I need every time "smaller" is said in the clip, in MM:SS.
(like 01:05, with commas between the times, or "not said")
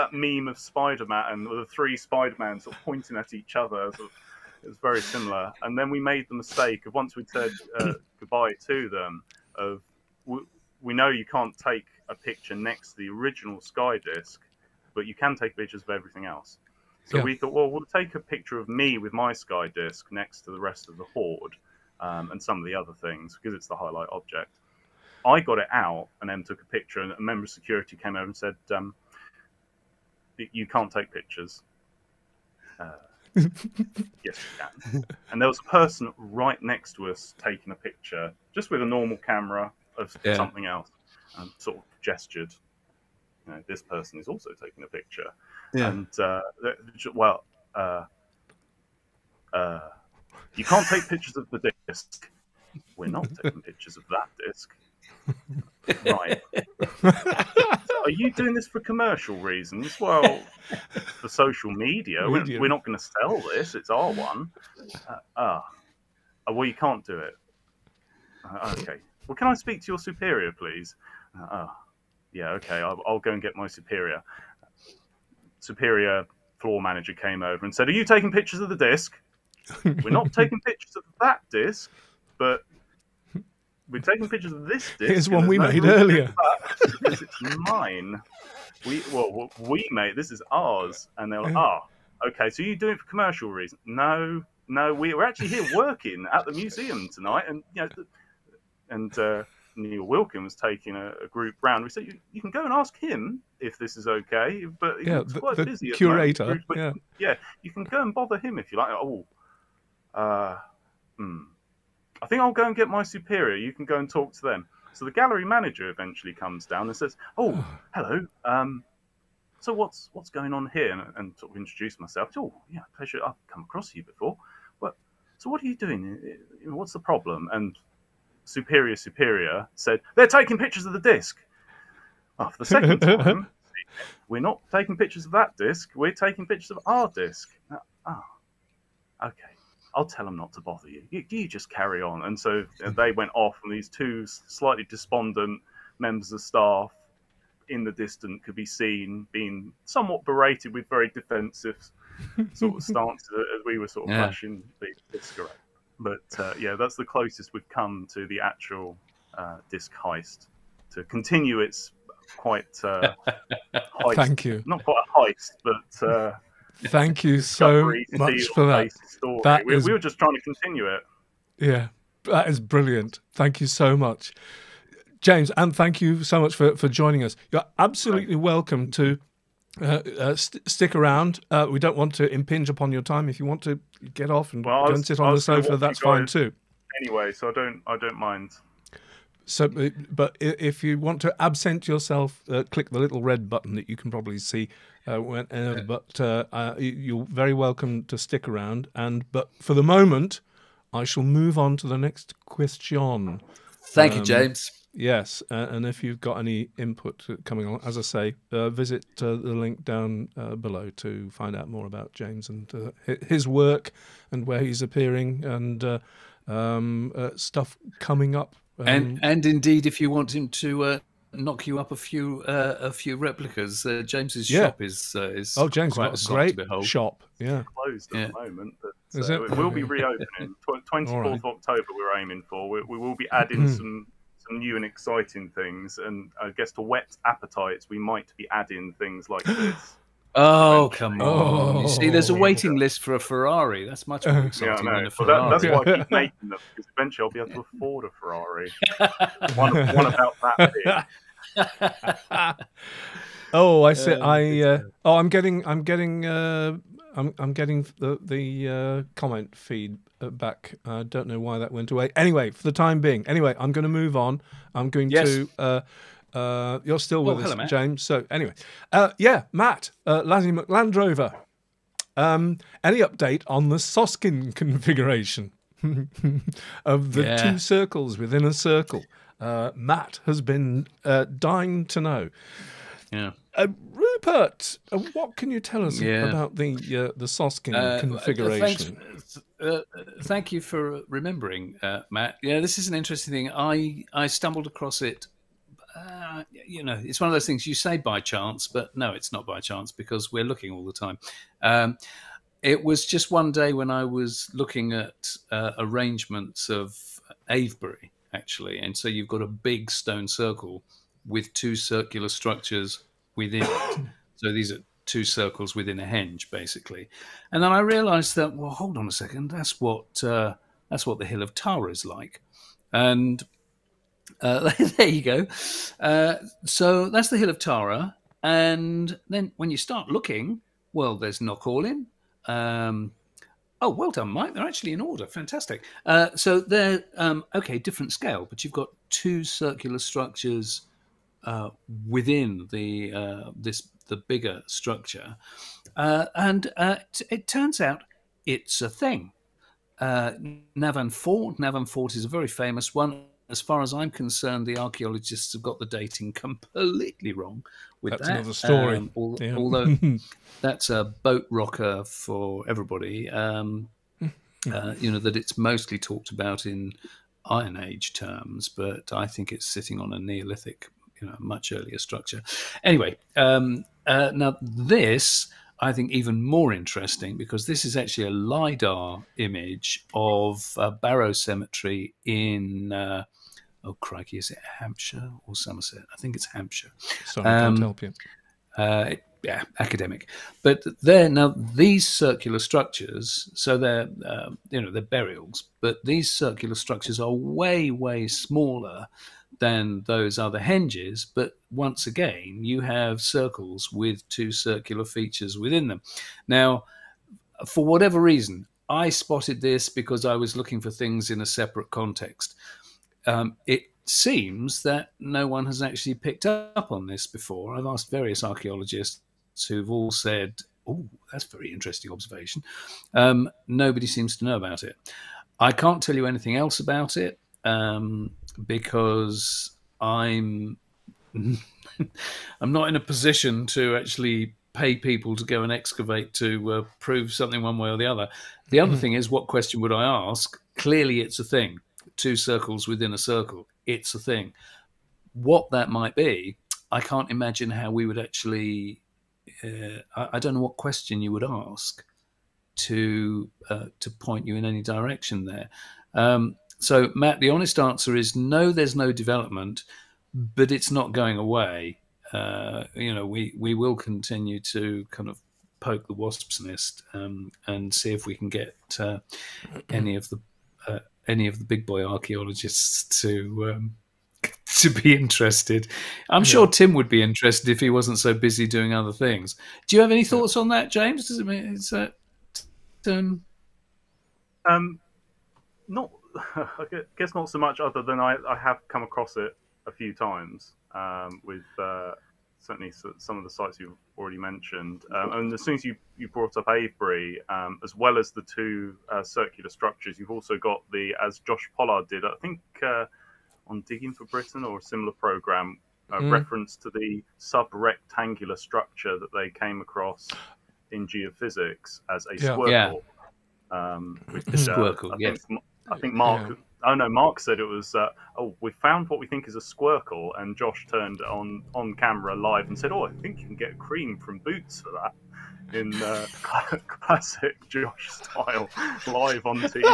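06:38.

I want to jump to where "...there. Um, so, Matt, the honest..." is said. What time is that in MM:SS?
07:35.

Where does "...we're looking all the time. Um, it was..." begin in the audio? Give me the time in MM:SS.
05:00.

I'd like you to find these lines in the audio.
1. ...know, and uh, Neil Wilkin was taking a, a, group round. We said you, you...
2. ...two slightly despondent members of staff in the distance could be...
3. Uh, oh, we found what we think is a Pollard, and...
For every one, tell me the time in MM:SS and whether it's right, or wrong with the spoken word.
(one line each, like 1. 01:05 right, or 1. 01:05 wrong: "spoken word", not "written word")
1. 01:37 right
2. 02:23 right
3. 08:37 wrong: "Squircle", not "Pollard".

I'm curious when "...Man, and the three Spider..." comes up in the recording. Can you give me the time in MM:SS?
00:01.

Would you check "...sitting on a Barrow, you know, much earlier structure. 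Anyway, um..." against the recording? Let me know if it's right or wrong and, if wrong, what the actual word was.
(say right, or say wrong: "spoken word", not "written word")
wrong: "Neolithic", not "Barrow".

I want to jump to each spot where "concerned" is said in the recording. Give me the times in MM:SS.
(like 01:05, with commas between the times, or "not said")
05:54.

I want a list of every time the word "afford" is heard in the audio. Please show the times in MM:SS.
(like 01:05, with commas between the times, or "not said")
04:07.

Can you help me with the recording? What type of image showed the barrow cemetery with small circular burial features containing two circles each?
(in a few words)
Lidar.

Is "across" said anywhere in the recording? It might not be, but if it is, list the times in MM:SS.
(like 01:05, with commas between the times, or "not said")
02:03, 04:54, 08:09, 08:29.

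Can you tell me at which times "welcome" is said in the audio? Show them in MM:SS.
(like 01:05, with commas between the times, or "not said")
02:58, 03:17.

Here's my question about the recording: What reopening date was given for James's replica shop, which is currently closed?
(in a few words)
24 October.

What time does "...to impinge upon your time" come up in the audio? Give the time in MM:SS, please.
03:02.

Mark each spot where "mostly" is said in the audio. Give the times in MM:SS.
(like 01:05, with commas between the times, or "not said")
06:05.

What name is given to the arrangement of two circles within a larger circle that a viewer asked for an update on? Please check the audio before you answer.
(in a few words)
Soskin configuration.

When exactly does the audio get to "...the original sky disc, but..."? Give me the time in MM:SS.
00:12.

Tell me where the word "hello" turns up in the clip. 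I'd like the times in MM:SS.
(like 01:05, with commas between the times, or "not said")
01:57, 04:27.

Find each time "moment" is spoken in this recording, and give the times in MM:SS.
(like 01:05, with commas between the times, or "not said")
03:19, 03:48.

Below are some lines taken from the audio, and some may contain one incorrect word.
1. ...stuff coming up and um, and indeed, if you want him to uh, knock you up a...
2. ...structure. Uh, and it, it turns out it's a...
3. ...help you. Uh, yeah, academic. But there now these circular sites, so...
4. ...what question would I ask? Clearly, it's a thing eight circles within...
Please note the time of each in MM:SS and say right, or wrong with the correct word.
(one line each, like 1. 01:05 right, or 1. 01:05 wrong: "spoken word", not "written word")
1. 03:37 right
2. 05:44 right
3. 06:27 wrong: "structures", not "sites"
4. 07:19 wrong: "two", not "eight".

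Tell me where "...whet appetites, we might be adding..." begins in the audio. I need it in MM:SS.
03:56.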